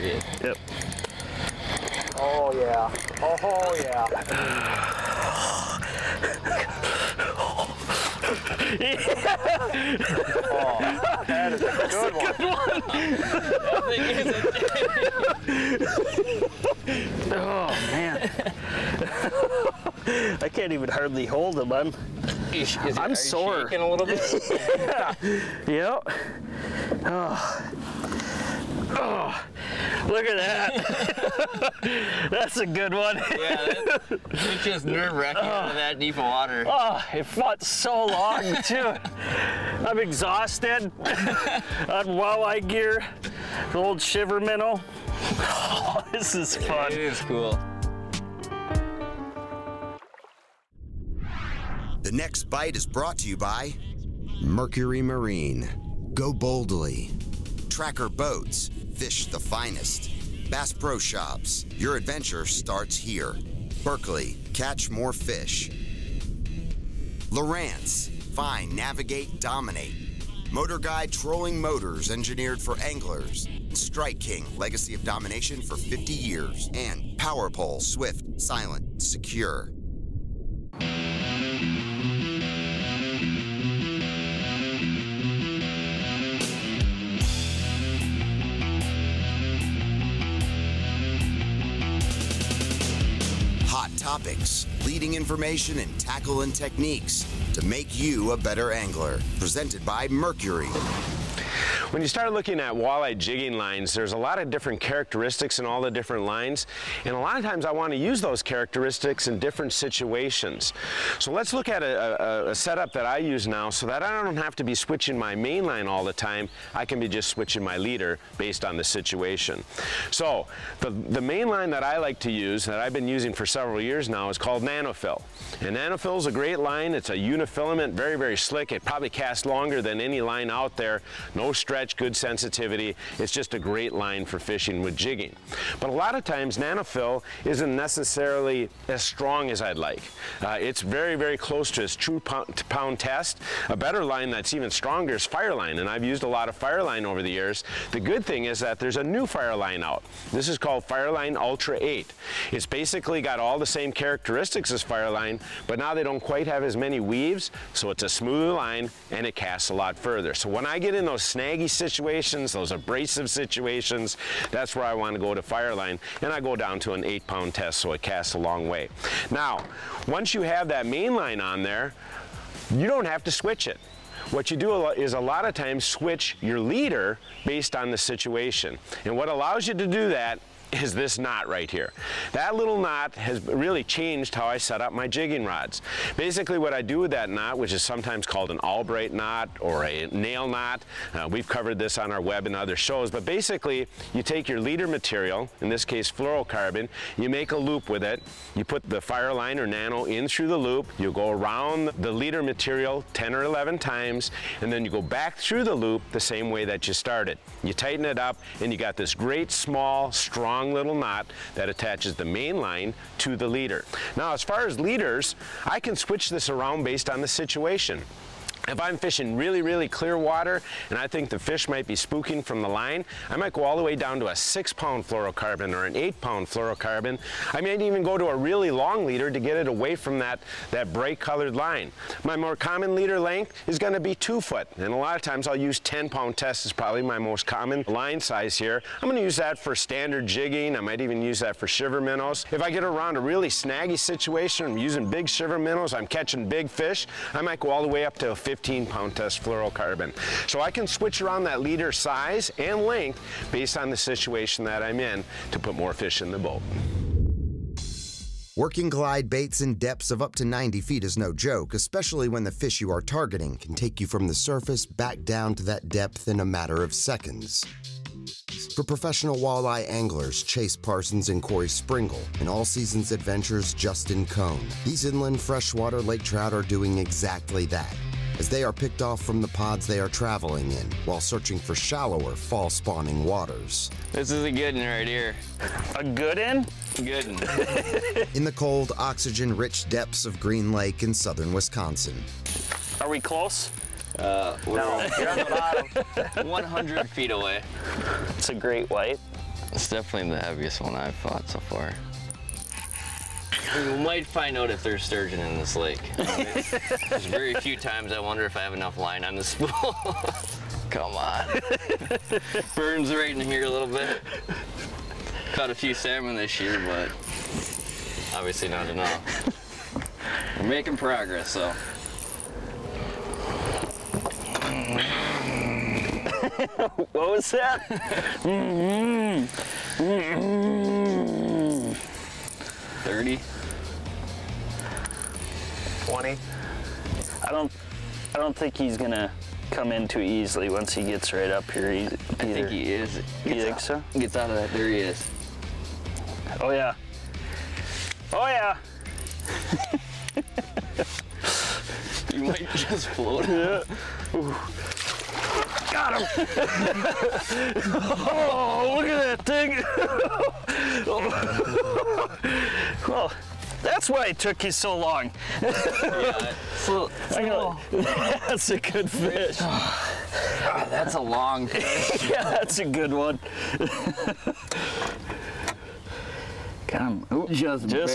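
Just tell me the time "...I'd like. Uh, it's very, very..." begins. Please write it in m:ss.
2:19.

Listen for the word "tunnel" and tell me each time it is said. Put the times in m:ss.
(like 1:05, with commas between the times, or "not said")
not said.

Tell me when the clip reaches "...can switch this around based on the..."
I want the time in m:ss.
3:35.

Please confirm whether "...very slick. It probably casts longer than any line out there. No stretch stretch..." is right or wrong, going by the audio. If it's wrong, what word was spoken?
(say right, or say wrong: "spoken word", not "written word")
right.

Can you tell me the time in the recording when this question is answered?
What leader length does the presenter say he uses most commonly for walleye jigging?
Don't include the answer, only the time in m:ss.
3:54.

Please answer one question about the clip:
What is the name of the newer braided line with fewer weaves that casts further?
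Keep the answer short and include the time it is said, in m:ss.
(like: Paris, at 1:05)
Fireline Ultra 8, at 2:30.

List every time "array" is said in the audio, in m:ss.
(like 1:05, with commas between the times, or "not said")
not said.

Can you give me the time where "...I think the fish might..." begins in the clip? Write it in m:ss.
3:40.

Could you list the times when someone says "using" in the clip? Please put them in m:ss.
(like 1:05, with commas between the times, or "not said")
2:03, 4:04.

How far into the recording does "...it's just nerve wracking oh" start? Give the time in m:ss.
0:34.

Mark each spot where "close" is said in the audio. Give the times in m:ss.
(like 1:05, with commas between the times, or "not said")
2:21, 4:53.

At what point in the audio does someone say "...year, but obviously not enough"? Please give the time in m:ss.
5:16.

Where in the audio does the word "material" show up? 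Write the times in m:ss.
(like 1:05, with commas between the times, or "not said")
3:14, 3:22.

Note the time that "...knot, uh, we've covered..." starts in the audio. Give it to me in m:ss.
3:10.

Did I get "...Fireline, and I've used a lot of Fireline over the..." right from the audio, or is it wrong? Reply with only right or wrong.
right.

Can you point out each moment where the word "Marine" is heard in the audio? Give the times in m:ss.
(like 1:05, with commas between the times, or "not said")
0:55.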